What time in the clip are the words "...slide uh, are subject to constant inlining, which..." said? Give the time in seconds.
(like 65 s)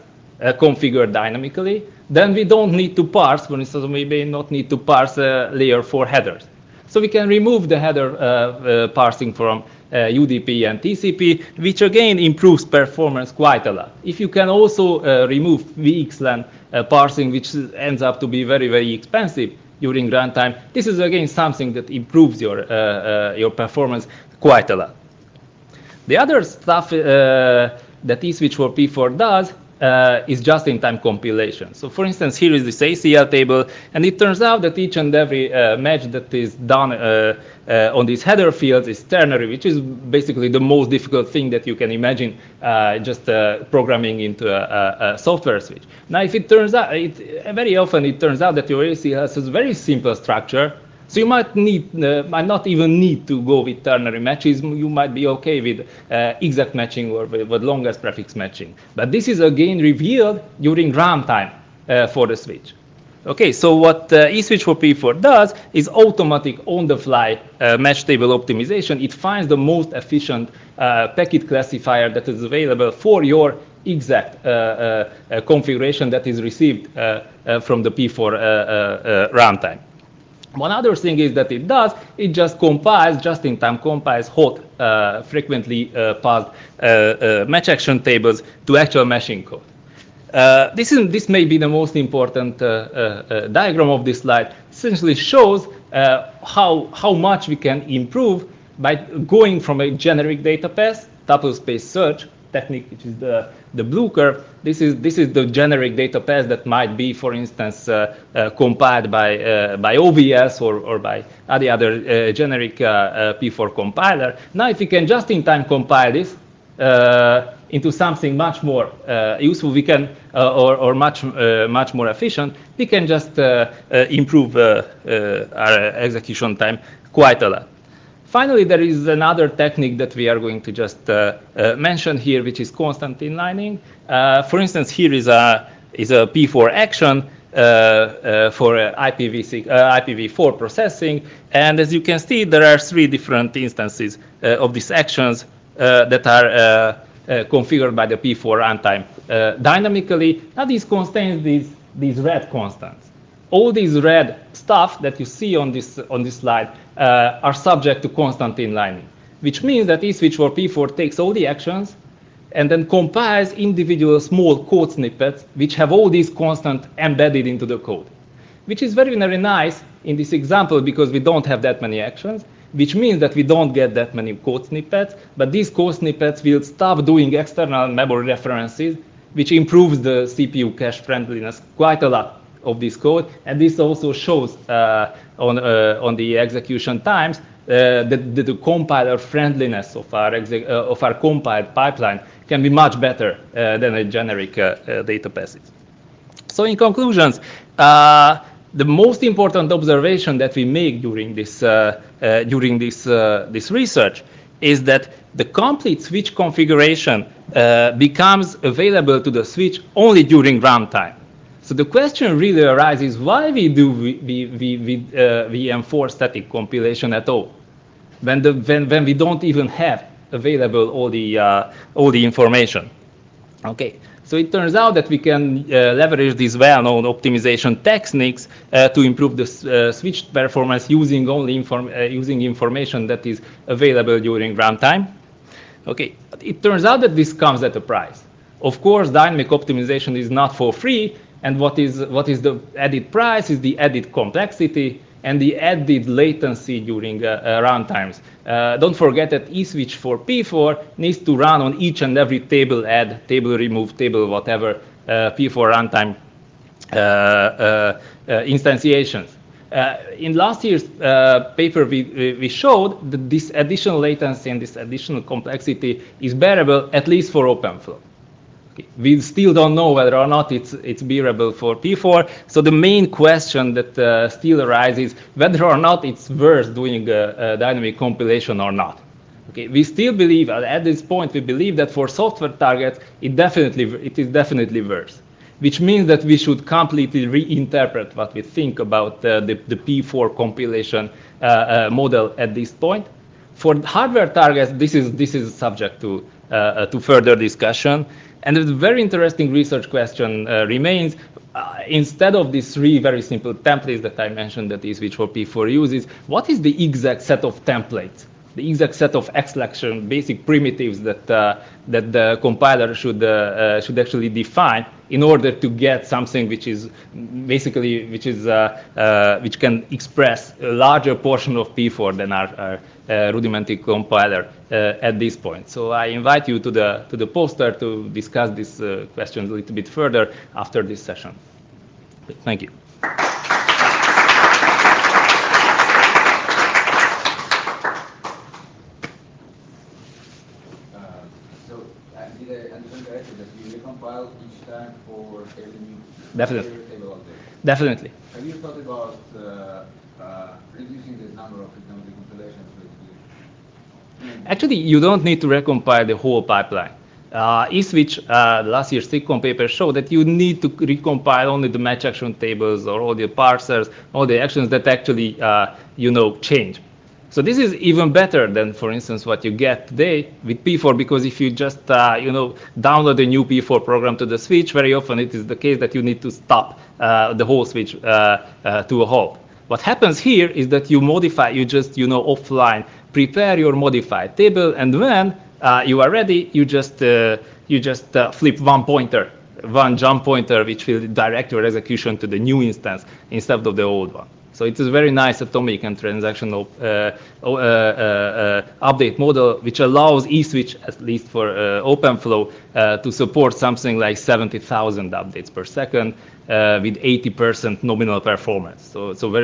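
156 s.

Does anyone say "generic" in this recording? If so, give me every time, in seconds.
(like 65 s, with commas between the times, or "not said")
99 s, 105 s, 112 s, 194 s.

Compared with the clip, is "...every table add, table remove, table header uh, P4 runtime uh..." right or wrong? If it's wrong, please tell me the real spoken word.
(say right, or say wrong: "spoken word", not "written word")
wrong: "whatever", not "header".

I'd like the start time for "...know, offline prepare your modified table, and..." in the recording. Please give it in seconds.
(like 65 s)
382 s.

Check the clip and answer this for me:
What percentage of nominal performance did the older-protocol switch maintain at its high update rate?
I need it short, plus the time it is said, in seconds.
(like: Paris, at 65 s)
80%, at 407 s.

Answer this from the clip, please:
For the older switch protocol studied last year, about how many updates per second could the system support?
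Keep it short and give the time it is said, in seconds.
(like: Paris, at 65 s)
70,000, at 404 s.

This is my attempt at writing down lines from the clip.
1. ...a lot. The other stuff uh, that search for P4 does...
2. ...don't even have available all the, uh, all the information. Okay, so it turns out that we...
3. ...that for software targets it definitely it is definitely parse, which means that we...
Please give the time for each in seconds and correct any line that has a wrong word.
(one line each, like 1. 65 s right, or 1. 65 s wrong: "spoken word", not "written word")
1. 24 s wrong: "eSwitch", not "search"
2. 219 s right
3. 281 s wrong: "worse", not "parse".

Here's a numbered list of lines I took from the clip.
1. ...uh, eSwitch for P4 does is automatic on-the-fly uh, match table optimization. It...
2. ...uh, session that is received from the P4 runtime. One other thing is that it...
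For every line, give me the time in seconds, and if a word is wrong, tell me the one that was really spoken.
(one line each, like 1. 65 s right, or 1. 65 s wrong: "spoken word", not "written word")
1. 64 s right
2. 75 s wrong: "configuration", not "session".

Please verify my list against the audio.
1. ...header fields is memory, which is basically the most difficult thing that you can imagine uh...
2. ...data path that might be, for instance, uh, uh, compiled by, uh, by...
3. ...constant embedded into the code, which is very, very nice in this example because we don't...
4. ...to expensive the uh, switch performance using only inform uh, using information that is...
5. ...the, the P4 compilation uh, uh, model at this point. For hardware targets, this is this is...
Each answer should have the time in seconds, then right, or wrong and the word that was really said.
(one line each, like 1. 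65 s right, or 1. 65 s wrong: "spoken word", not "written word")
1. 38 s wrong: "ternary", not "memory"
2. 105 s right
3. 166 s right
4. 228 s wrong: "improve", not "expensive"
5. 289 s right.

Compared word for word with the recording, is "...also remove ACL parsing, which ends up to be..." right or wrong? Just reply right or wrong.
wrong.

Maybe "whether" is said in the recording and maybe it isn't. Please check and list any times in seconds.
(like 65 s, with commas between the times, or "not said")
269 s, 275 s.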